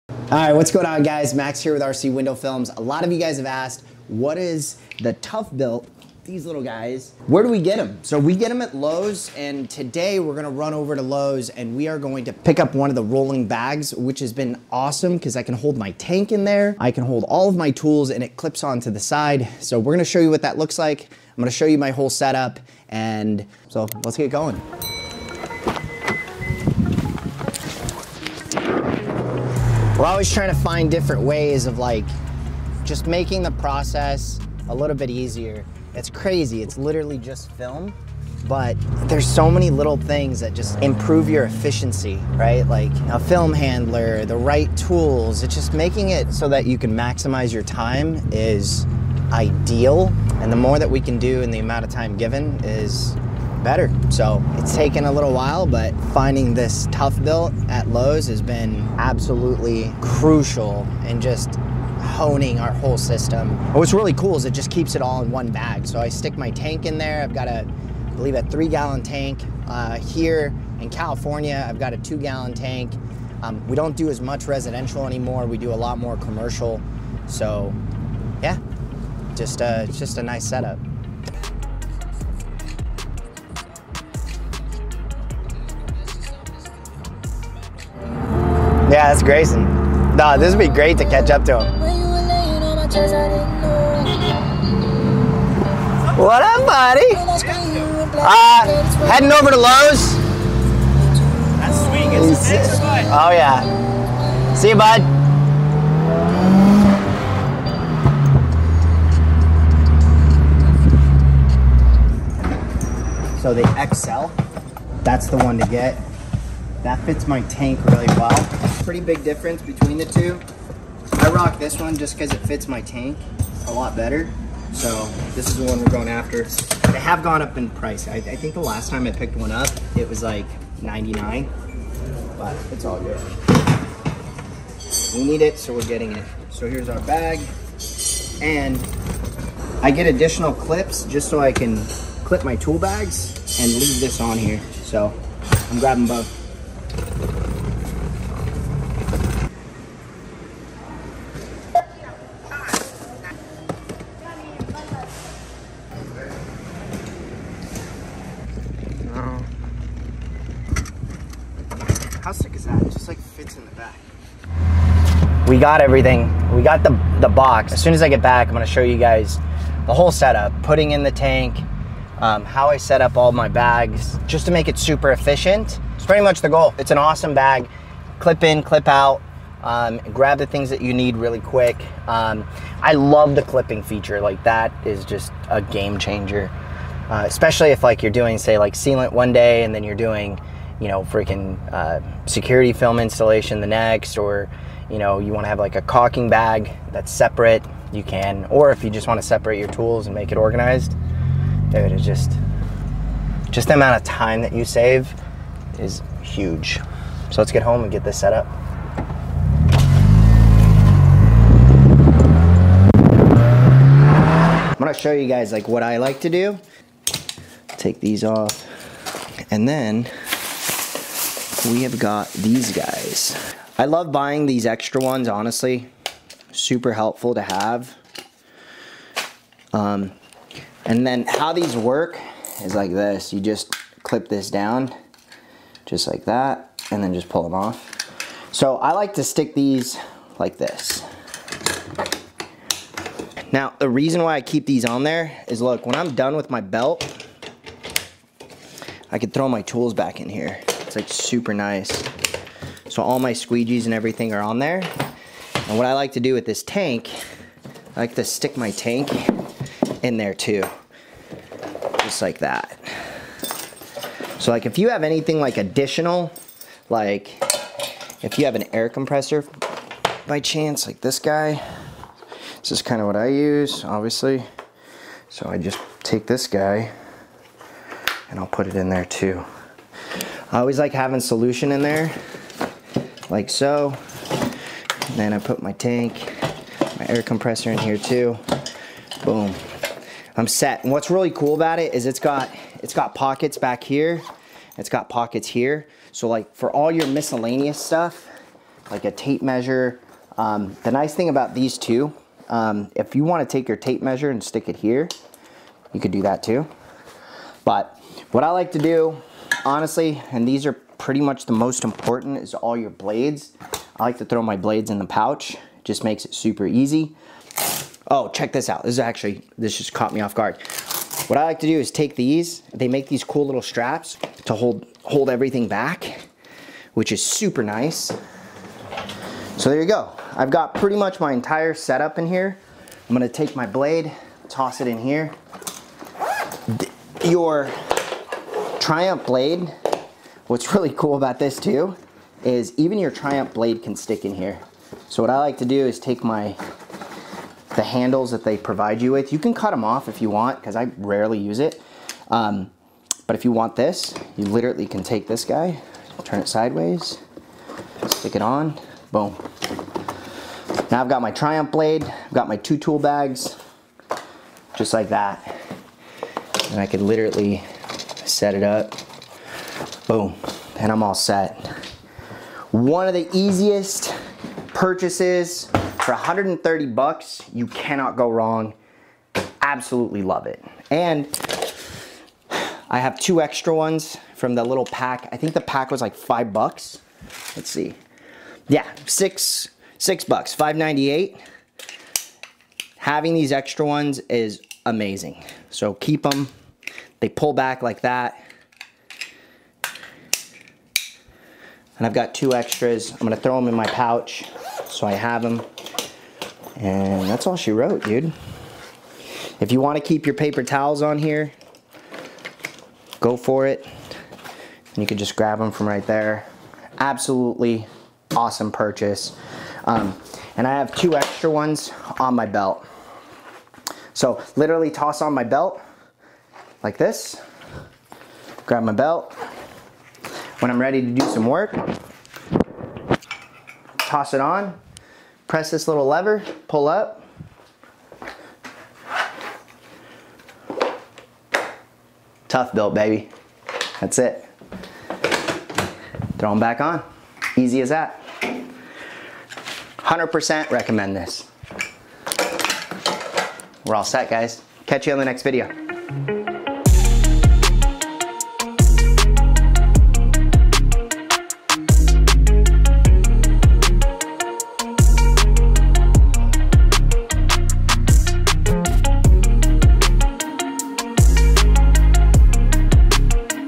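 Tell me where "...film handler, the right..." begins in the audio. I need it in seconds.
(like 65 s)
43 s.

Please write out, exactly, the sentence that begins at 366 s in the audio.
And I could literally set it up, boom, and I'm all set.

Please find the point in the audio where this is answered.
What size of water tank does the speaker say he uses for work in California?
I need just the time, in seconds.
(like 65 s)
71 s.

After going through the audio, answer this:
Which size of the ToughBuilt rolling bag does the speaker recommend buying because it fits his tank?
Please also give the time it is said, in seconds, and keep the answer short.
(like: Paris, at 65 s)
XL, at 113 s.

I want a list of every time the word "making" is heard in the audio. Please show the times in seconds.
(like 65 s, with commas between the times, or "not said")
33 s, 45 s.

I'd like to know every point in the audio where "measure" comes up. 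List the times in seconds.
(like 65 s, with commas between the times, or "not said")
299 s, 304 s.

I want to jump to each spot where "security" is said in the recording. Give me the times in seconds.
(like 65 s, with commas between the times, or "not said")
192 s.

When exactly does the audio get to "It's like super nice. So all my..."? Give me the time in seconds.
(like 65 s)
250 s.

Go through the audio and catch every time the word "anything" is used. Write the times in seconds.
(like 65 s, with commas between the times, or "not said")
265 s.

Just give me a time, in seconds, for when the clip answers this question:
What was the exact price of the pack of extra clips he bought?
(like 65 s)
390 s.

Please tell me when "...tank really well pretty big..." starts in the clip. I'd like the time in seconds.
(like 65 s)
117 s.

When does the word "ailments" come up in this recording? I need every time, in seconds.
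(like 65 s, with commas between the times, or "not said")
not said.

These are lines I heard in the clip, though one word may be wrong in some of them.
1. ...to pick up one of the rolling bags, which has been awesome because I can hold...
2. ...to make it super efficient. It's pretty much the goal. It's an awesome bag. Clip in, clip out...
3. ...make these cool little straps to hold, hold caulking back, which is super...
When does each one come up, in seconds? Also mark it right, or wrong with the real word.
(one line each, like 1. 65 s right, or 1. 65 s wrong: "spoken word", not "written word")
1. 12 s right
2. 174 s right
3. 322 s wrong: "everything", not "caulking".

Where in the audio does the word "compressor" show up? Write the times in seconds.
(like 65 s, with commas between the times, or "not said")
268 s, 287 s.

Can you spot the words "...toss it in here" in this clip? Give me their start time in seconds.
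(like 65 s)
334 s.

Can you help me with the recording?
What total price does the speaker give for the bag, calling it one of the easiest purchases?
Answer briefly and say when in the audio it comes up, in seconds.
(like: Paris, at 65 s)
130 bucks, at 376 s.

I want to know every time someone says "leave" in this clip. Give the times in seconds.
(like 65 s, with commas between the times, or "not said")
143 s.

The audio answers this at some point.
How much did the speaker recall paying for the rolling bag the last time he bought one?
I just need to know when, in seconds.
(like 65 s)
129 s.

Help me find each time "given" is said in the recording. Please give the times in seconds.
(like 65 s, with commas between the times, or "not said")
52 s.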